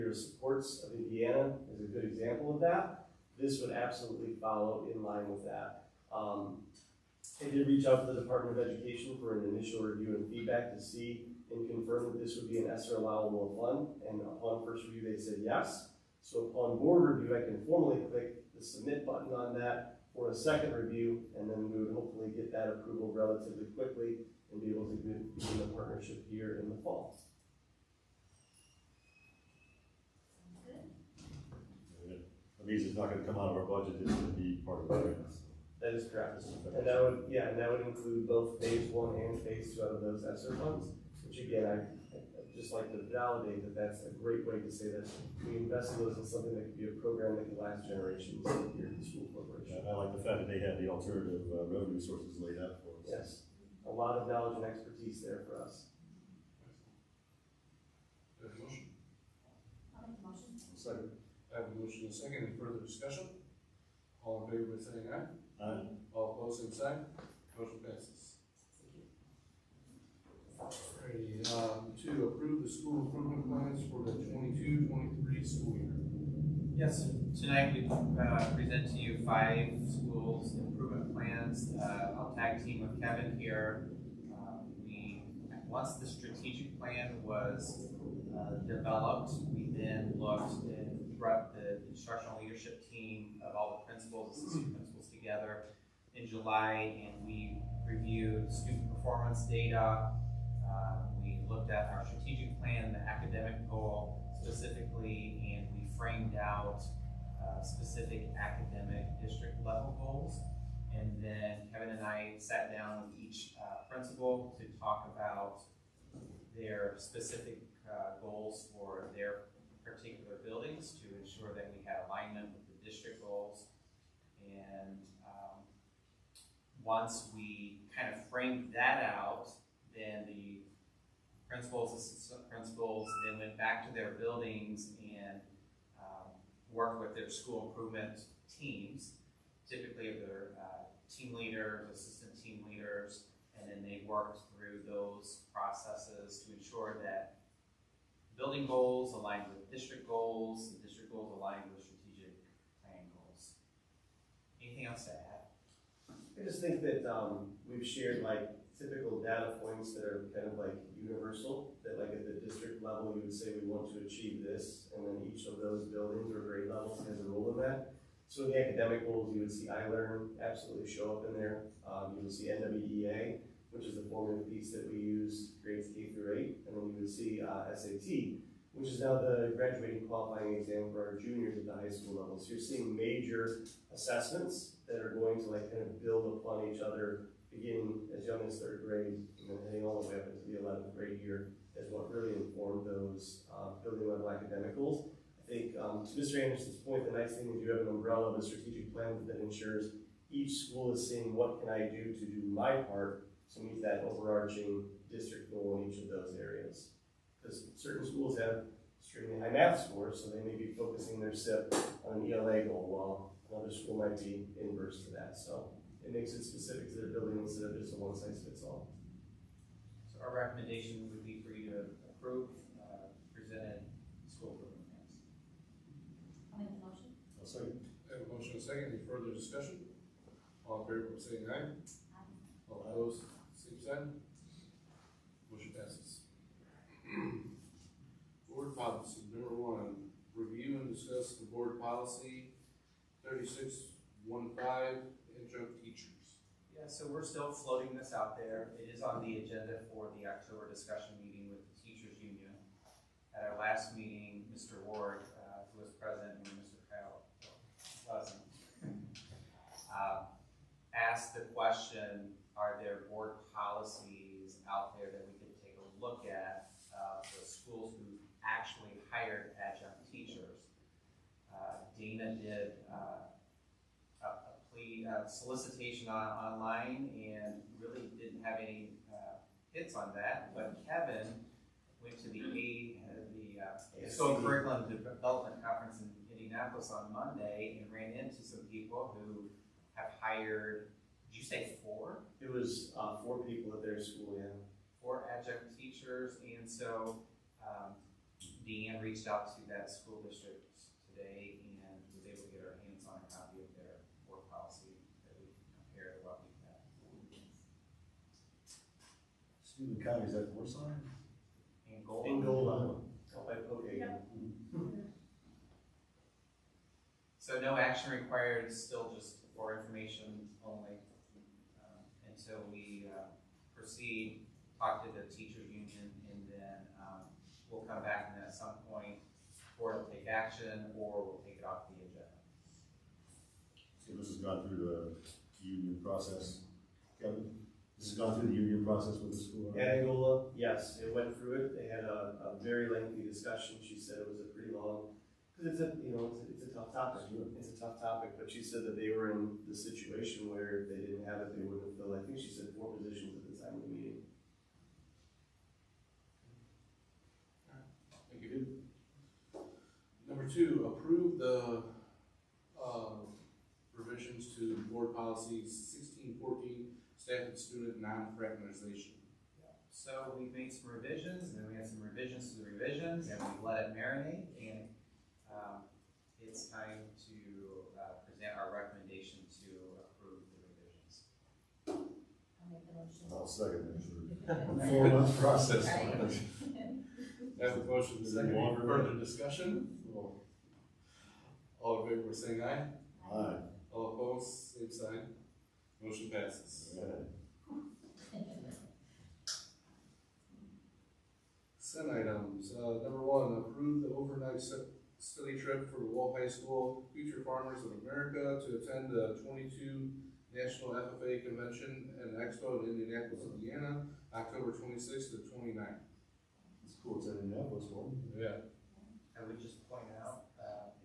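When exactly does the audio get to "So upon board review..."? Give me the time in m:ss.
0:16.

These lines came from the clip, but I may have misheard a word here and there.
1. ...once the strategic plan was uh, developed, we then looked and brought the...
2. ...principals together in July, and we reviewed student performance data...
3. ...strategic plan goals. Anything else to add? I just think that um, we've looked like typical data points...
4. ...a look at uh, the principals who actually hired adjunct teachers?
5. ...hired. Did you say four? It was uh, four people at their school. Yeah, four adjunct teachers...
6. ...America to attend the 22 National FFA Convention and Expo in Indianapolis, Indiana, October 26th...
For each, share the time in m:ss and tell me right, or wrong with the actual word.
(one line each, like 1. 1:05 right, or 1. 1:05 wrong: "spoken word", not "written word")
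1. 1:25 right
2. 1:34 right
3. 2:31 wrong: "shared", not "looked"
4. 4:25 wrong: "schools", not "principals"
5. 4:50 right
6. 6:48 right.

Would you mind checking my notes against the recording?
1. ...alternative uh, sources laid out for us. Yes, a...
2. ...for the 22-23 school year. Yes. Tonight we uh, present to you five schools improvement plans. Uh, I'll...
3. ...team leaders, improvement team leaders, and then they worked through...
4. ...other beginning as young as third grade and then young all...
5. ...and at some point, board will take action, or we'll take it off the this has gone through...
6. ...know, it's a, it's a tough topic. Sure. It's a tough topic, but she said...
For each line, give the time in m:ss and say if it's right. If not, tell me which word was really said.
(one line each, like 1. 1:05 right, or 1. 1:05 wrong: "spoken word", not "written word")
1. 0:50 right
2. 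1:13 right
3. 2:21 wrong: "assistant", not "improvement"
4. 3:06 wrong: "heading", not "young"
5. 5:28 right
6. 5:46 right.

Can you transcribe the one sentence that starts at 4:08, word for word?
It is on the agenda for the October discussion meeting with the teachers union.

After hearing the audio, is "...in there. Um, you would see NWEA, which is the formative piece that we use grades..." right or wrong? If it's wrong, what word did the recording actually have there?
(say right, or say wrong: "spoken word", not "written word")
right.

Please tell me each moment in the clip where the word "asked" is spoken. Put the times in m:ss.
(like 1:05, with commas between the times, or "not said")
4:20.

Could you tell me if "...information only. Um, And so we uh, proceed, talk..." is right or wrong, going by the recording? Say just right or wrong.
right.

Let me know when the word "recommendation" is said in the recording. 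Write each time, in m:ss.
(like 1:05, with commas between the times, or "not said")
3:40, 6:18.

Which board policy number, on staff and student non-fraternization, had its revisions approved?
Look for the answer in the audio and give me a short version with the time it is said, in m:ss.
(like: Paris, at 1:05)
1614, at 6:05.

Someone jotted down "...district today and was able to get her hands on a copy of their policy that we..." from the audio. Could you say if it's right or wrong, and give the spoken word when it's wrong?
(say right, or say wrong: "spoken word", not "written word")
right.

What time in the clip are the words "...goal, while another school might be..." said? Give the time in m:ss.
3:32.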